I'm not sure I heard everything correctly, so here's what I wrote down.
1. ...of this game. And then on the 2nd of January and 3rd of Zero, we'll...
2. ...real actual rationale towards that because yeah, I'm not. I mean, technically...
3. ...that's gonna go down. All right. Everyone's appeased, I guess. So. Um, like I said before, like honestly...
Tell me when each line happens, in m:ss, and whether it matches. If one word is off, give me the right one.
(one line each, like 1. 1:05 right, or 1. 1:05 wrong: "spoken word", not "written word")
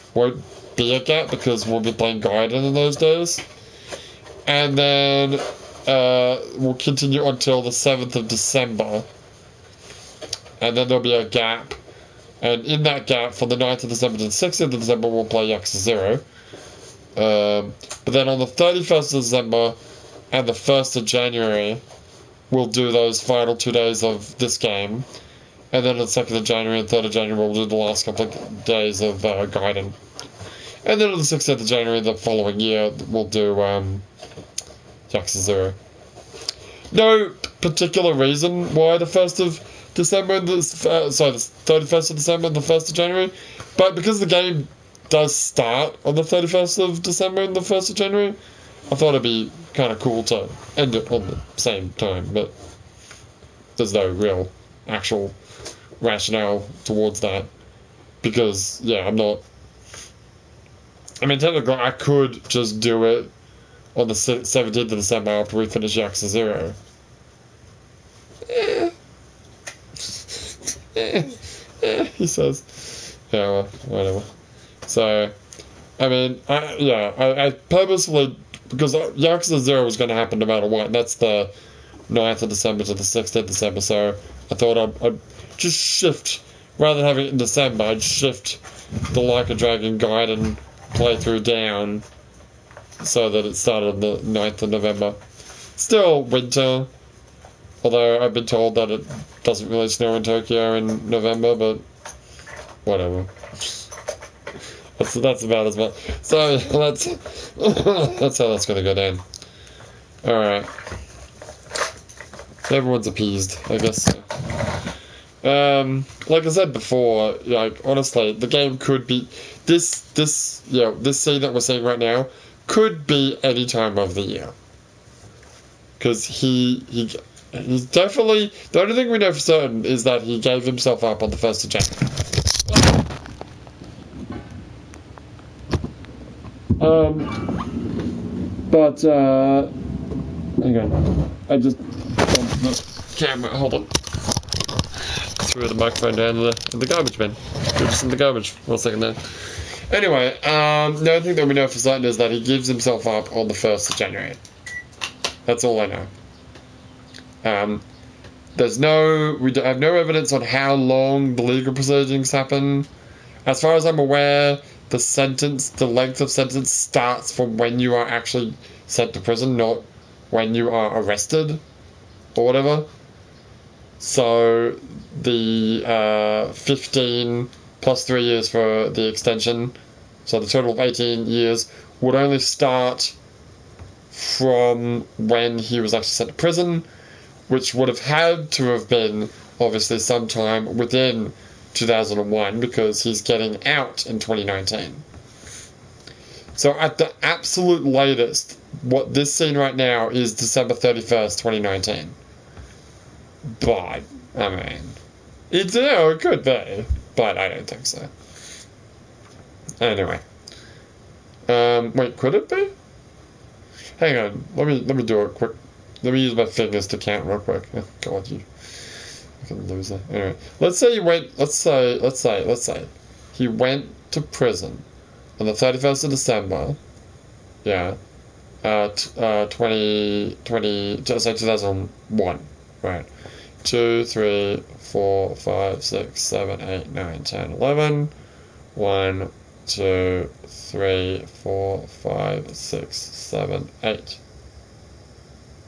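1. 0:24 wrong: "January", not "Zero"
2. 0:54 right
3. 1:48 right.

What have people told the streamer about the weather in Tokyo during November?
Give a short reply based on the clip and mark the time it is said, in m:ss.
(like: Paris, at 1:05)
It doesn't really snow, at 1:39.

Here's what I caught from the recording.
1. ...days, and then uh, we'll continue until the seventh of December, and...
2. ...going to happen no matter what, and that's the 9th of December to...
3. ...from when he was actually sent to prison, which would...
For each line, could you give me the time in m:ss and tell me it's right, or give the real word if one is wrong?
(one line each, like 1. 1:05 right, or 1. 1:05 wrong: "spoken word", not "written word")
1. 0:02 right
2. 1:19 right
3. 3:04 right.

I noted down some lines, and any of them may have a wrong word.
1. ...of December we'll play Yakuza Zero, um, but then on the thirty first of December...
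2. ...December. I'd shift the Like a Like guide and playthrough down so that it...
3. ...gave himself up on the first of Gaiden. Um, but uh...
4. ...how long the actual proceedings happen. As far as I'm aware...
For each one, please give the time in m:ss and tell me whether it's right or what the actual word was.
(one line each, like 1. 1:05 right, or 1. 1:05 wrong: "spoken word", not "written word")
1. 0:14 right
2. 1:27 wrong: "Dragon", not "Like"
3. 2:10 wrong: "January", not "Gaiden"
4. 2:40 wrong: "legal", not "actual".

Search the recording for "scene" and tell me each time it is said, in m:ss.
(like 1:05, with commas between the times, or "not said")
2:01, 3:19.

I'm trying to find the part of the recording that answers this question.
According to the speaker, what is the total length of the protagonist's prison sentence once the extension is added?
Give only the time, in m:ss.
3:00.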